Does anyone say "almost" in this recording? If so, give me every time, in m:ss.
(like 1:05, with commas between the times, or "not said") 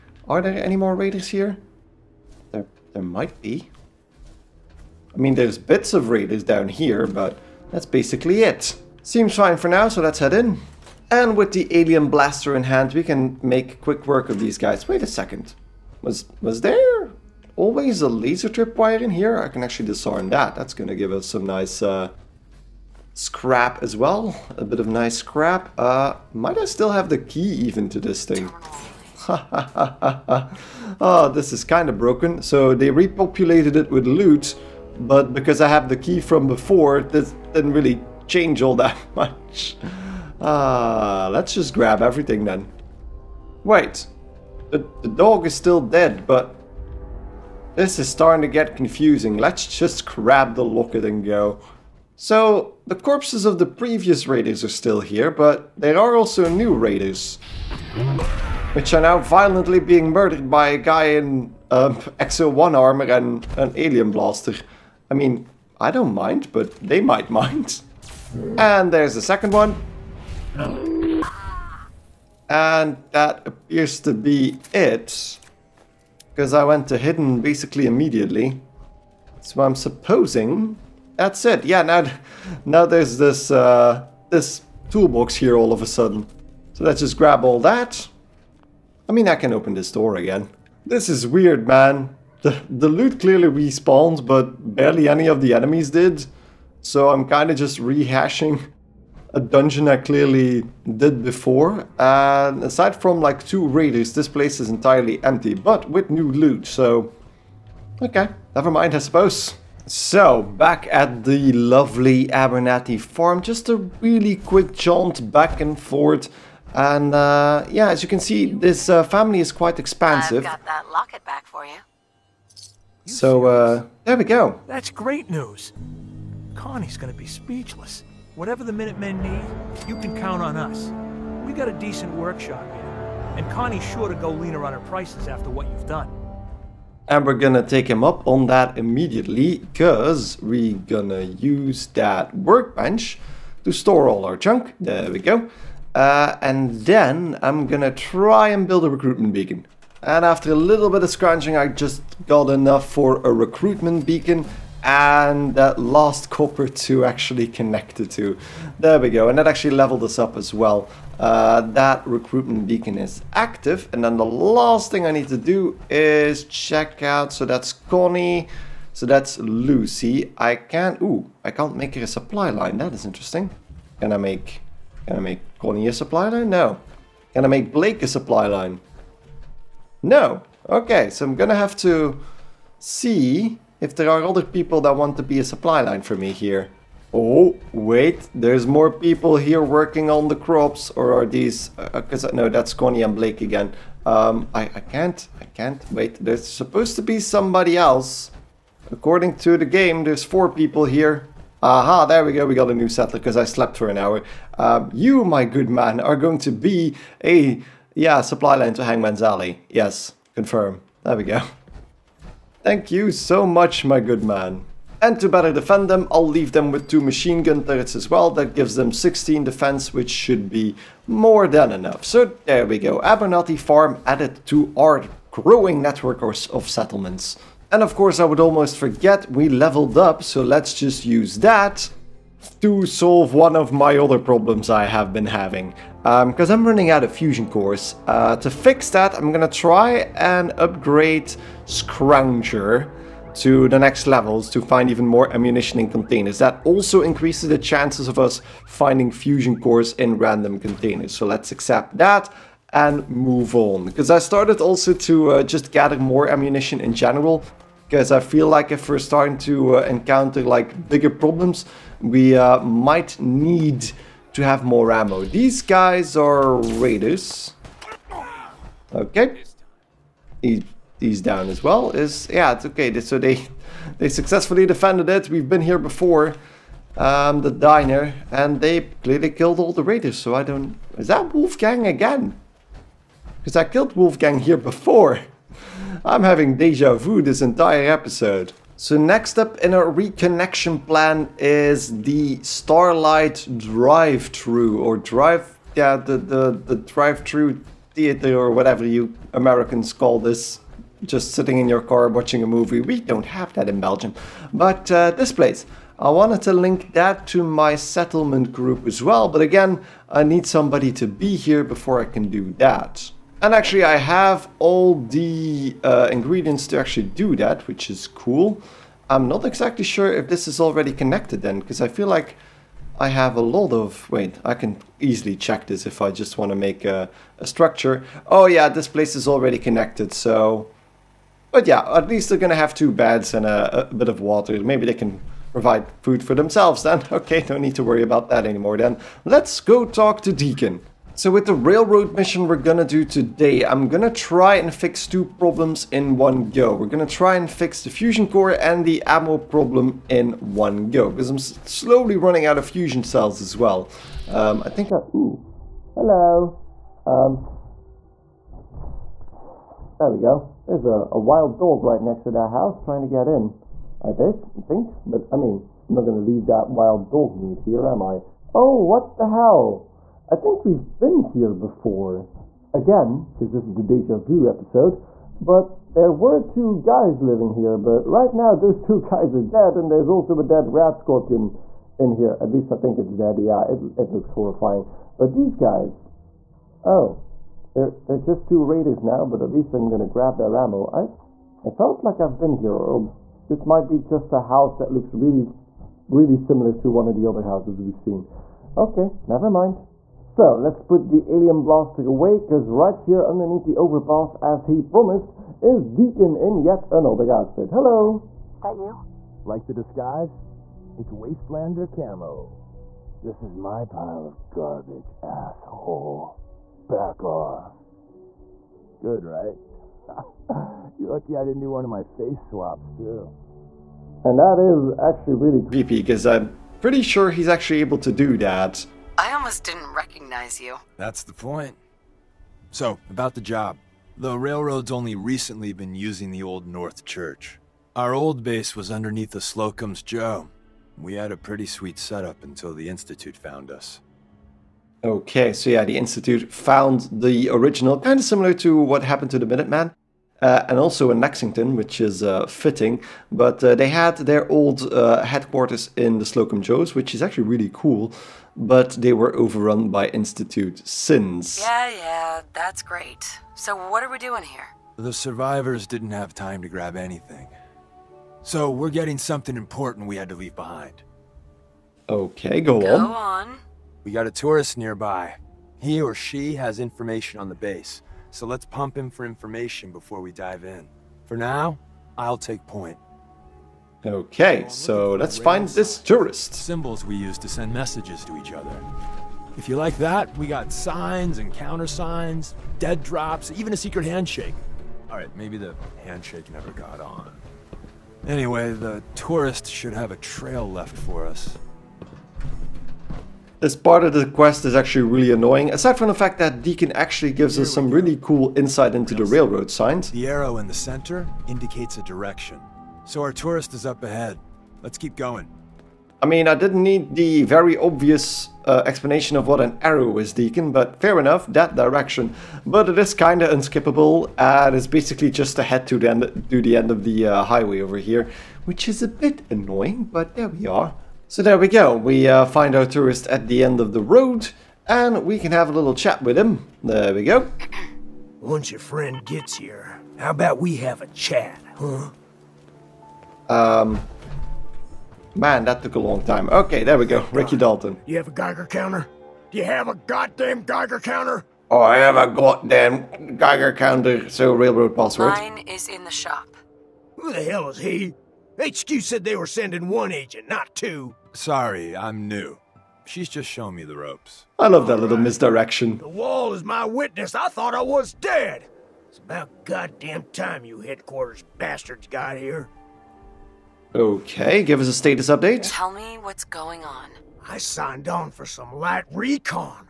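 3:48, 7:09.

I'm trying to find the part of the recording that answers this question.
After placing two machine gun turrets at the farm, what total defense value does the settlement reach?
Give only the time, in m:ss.
3:38.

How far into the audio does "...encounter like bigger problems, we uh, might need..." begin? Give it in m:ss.
4:19.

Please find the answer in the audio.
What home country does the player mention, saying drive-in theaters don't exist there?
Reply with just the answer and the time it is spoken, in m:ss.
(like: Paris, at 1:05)
Belgium, at 5:03.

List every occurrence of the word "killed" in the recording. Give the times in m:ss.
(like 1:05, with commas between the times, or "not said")
4:39, 4:43.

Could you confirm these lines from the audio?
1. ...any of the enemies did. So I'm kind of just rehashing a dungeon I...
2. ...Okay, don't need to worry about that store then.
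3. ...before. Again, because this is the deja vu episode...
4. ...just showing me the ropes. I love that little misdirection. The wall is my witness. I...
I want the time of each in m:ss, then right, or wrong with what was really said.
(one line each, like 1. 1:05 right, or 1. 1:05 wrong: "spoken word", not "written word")
1. 1:35 right
2. 5:37 wrong: "anymore", not "store"
3. 6:11 right
4. 9:23 right.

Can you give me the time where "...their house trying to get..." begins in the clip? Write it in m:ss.
6:02.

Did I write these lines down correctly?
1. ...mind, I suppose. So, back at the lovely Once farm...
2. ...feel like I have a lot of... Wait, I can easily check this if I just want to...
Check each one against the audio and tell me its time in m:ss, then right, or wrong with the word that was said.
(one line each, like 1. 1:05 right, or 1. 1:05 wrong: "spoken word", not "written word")
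1. 1:48 wrong: "Abernathy", not "Once"
2. 5:21 right.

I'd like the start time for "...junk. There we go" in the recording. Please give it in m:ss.
2:24.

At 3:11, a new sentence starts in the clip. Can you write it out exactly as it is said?
Because uh, uh, No, that's Connie and Blake again.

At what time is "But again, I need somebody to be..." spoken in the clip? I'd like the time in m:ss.
5:09.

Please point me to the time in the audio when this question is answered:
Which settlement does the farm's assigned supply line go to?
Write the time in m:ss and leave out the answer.
3:28.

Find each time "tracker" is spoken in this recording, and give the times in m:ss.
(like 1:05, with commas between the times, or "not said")
not said.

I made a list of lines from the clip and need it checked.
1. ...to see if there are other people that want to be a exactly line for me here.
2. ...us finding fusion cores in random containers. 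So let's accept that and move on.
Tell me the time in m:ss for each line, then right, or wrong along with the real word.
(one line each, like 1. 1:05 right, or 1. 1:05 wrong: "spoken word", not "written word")
1. 3:01 wrong: "supply", not "exactly"
2. 4:08 right.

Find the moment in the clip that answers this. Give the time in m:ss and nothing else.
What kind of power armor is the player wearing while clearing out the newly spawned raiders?
1:02.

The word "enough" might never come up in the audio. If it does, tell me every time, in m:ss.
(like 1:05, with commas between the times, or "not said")
2:32, 3:41, 8:41.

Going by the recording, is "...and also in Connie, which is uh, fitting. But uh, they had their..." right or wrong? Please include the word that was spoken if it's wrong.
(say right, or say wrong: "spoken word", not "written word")
wrong: "Lexington", not "Connie".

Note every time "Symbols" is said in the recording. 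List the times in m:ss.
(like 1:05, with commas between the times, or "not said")
8:06.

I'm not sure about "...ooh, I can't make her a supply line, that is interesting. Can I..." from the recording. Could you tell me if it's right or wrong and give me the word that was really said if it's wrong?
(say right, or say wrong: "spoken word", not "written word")
right.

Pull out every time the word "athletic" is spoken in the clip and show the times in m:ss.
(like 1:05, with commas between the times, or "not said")
not said.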